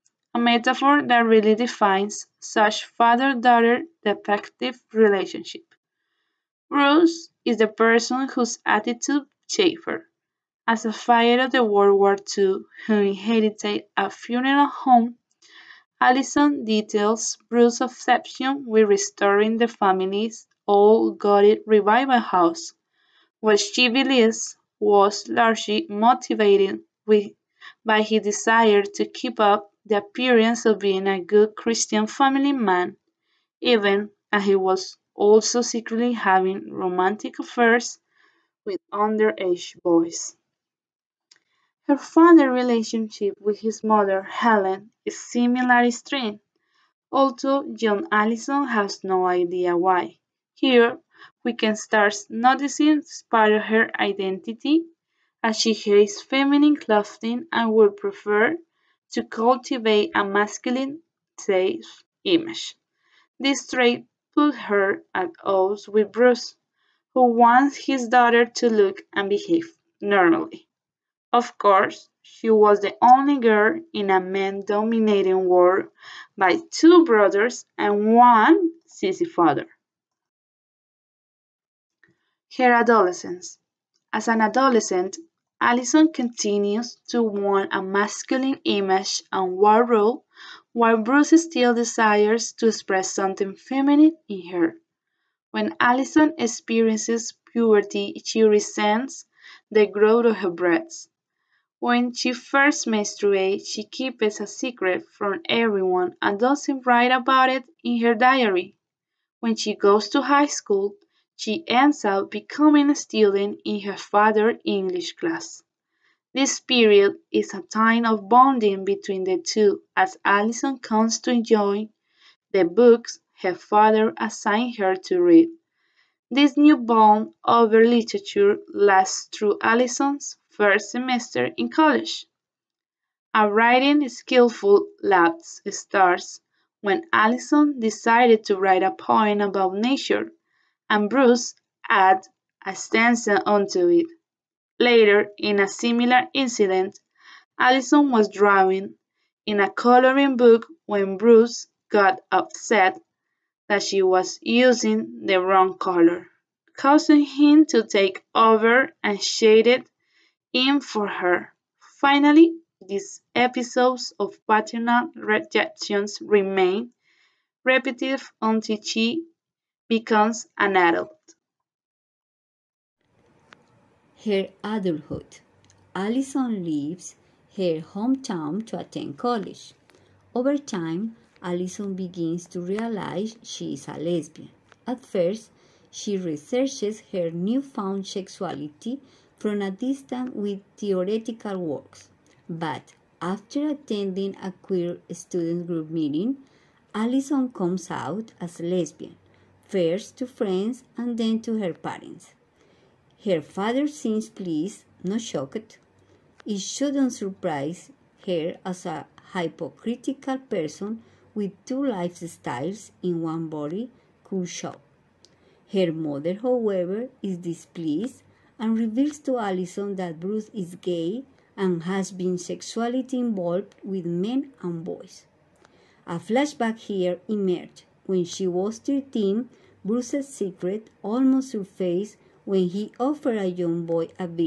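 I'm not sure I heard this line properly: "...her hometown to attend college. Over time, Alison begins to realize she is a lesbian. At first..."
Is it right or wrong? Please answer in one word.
right.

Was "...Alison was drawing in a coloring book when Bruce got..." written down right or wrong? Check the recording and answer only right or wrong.
right.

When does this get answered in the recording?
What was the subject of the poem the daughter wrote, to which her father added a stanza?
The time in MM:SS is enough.
02:19.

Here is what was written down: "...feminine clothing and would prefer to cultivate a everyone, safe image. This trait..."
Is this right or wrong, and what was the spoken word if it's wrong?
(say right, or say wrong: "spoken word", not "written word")
wrong: "masculine", not "everyone".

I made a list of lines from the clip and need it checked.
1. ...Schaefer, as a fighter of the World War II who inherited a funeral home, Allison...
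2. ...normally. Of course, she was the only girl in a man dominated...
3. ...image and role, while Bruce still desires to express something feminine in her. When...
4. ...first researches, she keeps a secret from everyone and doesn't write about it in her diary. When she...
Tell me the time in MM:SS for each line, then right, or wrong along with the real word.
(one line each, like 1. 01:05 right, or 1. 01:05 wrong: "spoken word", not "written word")
1. 00:09 right
2. 01:09 right
3. 01:28 right
4. 01:42 wrong: "menstruates", not "researches".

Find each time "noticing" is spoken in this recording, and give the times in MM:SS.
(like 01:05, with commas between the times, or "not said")
00:52.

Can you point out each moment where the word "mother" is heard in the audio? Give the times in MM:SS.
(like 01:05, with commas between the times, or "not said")
00:43, 03:35.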